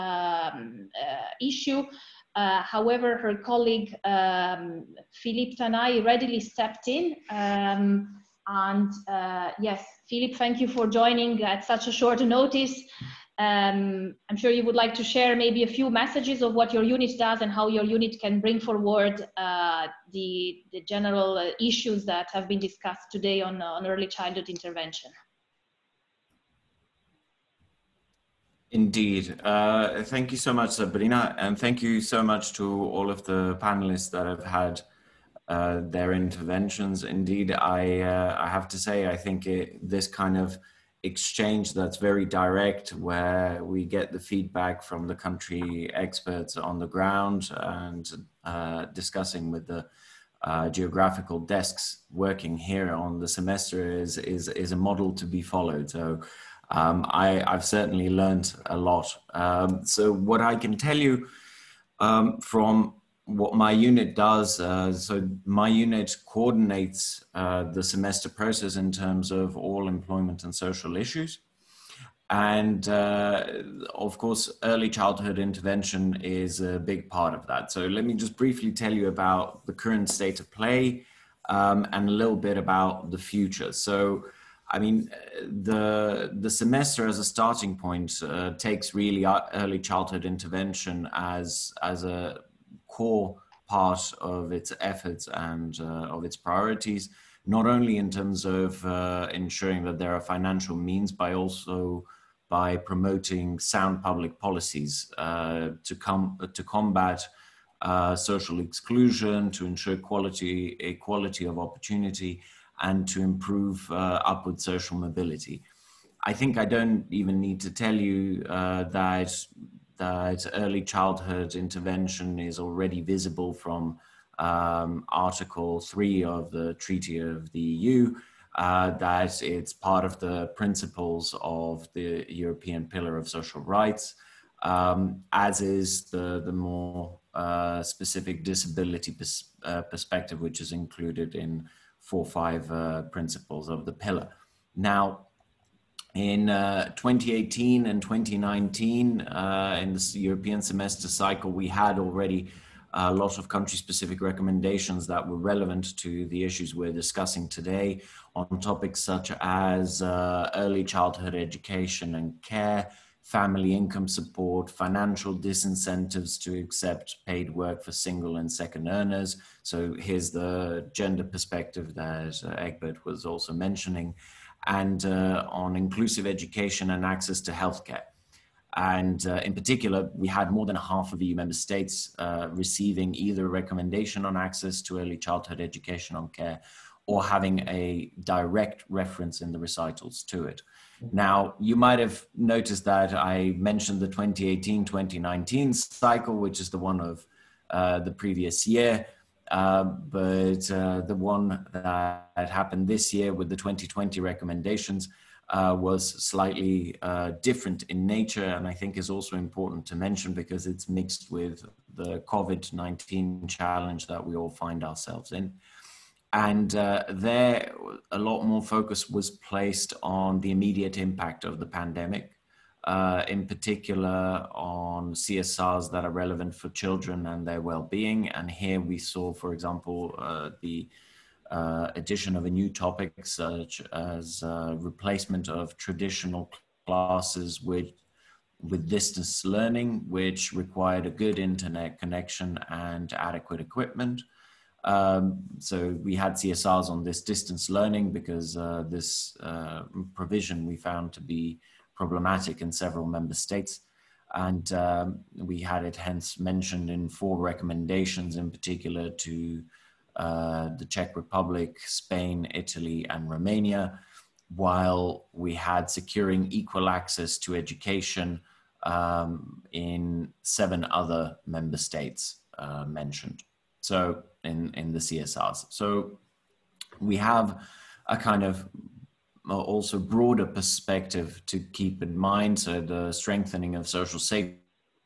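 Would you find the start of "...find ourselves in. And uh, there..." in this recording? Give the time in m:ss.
3:34.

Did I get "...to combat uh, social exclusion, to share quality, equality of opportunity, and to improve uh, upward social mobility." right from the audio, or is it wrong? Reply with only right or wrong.
wrong.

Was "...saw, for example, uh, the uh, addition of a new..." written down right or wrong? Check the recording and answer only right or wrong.
right.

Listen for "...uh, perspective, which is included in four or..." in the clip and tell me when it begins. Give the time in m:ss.
2:19.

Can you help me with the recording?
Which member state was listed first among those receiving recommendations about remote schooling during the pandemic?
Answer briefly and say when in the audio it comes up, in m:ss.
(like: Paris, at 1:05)
Czech Republic, at 4:20.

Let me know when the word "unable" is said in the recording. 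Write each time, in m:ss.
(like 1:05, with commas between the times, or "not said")
not said.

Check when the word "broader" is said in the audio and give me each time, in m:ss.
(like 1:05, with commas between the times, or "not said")
4:39.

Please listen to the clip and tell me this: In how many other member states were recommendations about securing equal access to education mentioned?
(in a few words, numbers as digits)
7.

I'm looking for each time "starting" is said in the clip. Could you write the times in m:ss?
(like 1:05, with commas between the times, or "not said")
1:27.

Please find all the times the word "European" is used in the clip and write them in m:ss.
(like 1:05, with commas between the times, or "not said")
2:12, 2:30.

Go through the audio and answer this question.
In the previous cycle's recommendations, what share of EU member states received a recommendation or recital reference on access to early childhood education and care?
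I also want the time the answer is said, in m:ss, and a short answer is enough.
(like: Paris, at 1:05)
more than half, at 3:00.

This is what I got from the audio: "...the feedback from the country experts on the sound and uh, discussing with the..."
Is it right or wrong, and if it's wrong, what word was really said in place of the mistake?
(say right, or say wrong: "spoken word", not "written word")
wrong: "ground", not "sound".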